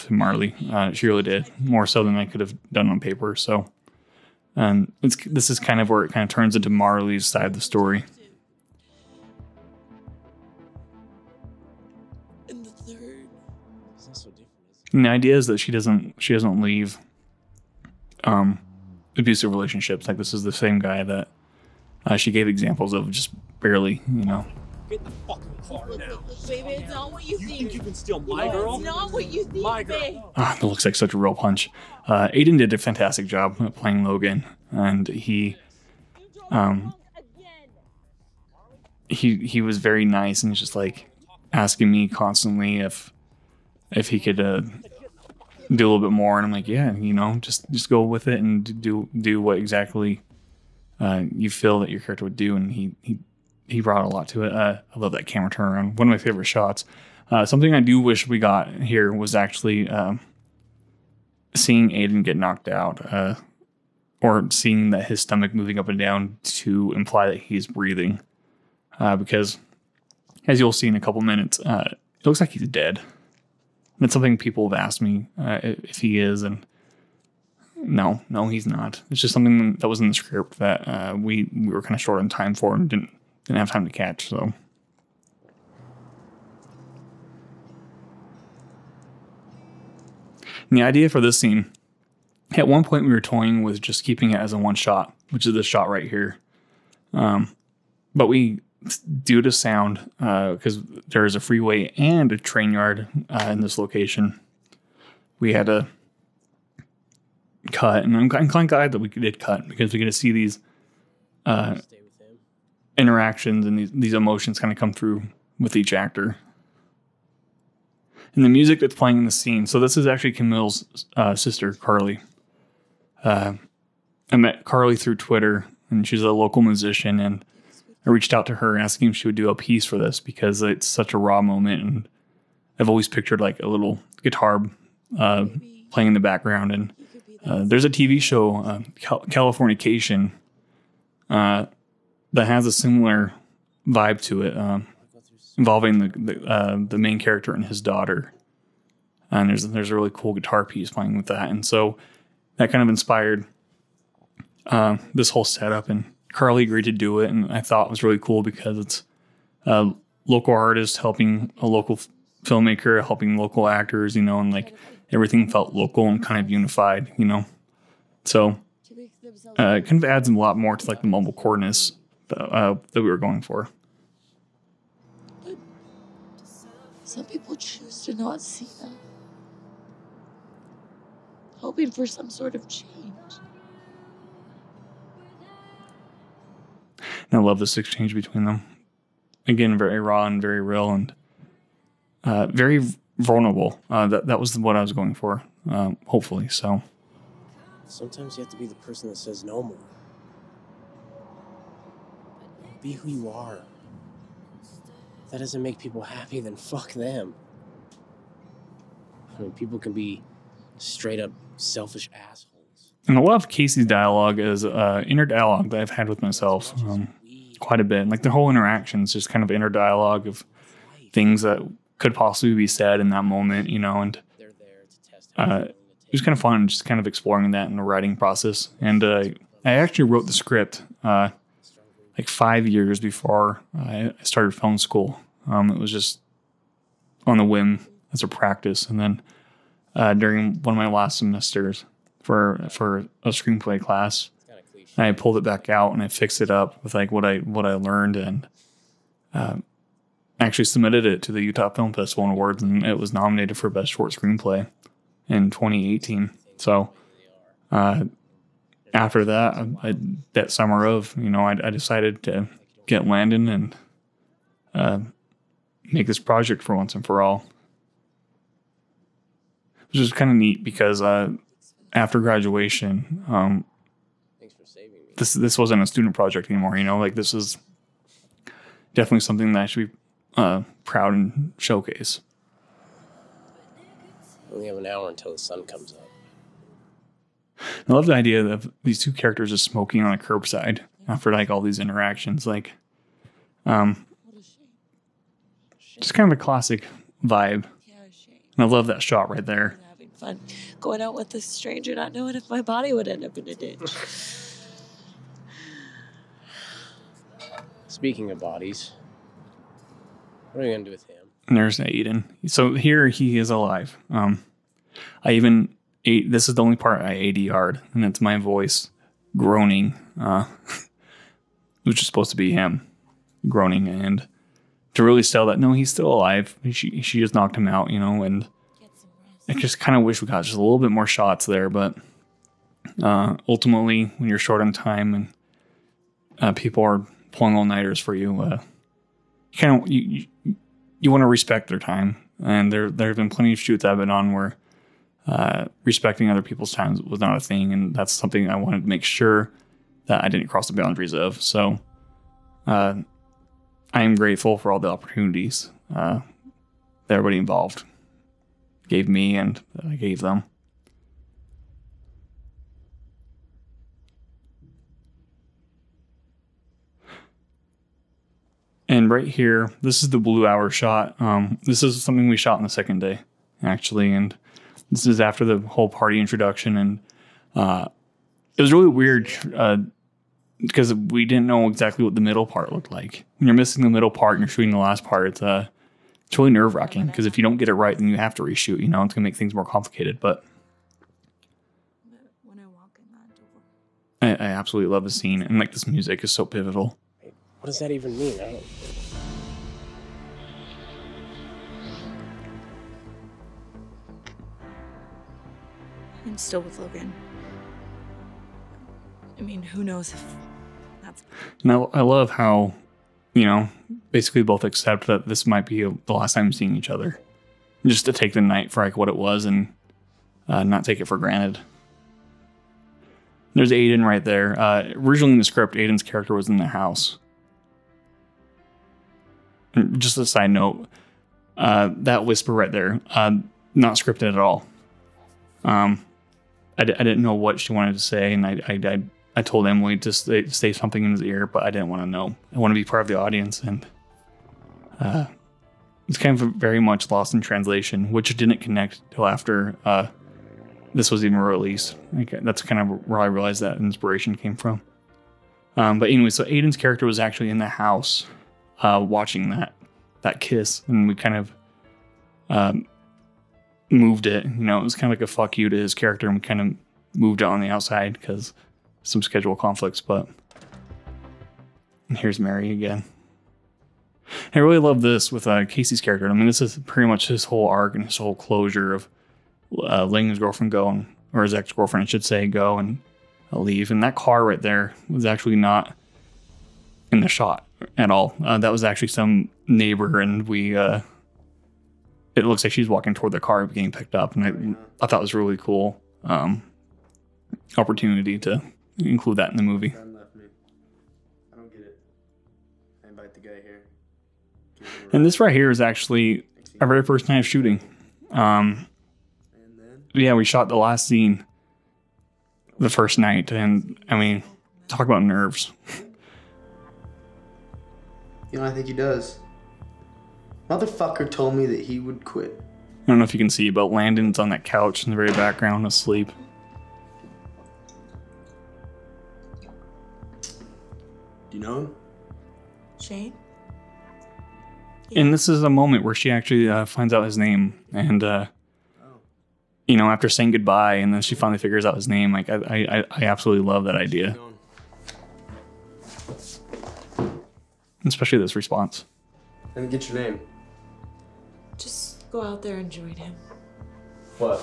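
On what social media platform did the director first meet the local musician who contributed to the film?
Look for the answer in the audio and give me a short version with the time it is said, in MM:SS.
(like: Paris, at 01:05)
Twitter, at 02:05.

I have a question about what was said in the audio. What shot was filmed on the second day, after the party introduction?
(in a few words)
blue hour shot.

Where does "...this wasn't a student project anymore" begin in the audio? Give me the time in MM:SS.
04:35.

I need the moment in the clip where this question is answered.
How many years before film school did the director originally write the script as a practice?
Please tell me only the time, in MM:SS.
03:52.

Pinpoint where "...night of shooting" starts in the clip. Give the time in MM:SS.
08:27.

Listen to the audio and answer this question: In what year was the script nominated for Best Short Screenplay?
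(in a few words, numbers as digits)
2018.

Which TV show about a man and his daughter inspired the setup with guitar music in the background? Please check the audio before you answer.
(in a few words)
Californication.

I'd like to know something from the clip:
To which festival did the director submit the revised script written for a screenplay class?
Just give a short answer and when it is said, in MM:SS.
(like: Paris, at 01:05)
Utah Film Festival and Awards, at 04:11.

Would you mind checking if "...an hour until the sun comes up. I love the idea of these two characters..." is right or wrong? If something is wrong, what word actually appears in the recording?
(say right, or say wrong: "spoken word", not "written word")
right.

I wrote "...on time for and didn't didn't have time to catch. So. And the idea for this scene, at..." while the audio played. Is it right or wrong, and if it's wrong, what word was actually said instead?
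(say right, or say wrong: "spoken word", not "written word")
right.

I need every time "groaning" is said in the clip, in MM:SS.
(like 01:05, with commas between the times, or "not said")
05:19, 05:23.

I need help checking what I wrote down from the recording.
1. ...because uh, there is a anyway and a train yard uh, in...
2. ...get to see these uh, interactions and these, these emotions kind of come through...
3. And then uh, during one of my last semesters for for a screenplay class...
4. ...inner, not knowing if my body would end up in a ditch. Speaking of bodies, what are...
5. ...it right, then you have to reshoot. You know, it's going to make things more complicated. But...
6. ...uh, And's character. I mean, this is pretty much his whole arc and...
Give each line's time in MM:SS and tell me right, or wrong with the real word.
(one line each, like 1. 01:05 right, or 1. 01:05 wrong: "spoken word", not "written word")
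1. 01:40 wrong: "freeway", not "anyway"
2. 01:49 right
3. 03:58 right
4. 05:01 wrong: "stranger", not "inner"
5. 06:27 right
6. 07:55 wrong: "Casey", not "And".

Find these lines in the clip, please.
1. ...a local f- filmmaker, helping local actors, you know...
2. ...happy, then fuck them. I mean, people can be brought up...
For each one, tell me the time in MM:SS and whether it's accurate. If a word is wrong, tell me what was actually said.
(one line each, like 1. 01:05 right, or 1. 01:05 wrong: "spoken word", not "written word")
1. 02:41 right
2. 03:26 wrong: "straight", not "brought".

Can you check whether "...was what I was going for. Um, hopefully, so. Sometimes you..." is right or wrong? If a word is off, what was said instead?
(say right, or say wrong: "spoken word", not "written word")
right.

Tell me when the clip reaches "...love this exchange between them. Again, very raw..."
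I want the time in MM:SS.
03:07.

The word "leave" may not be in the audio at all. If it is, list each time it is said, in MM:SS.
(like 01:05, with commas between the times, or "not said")
00:16, 08:03.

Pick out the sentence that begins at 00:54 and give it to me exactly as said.
Uh, I love that camera turnaround.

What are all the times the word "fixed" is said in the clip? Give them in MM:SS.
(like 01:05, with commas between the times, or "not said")
04:06.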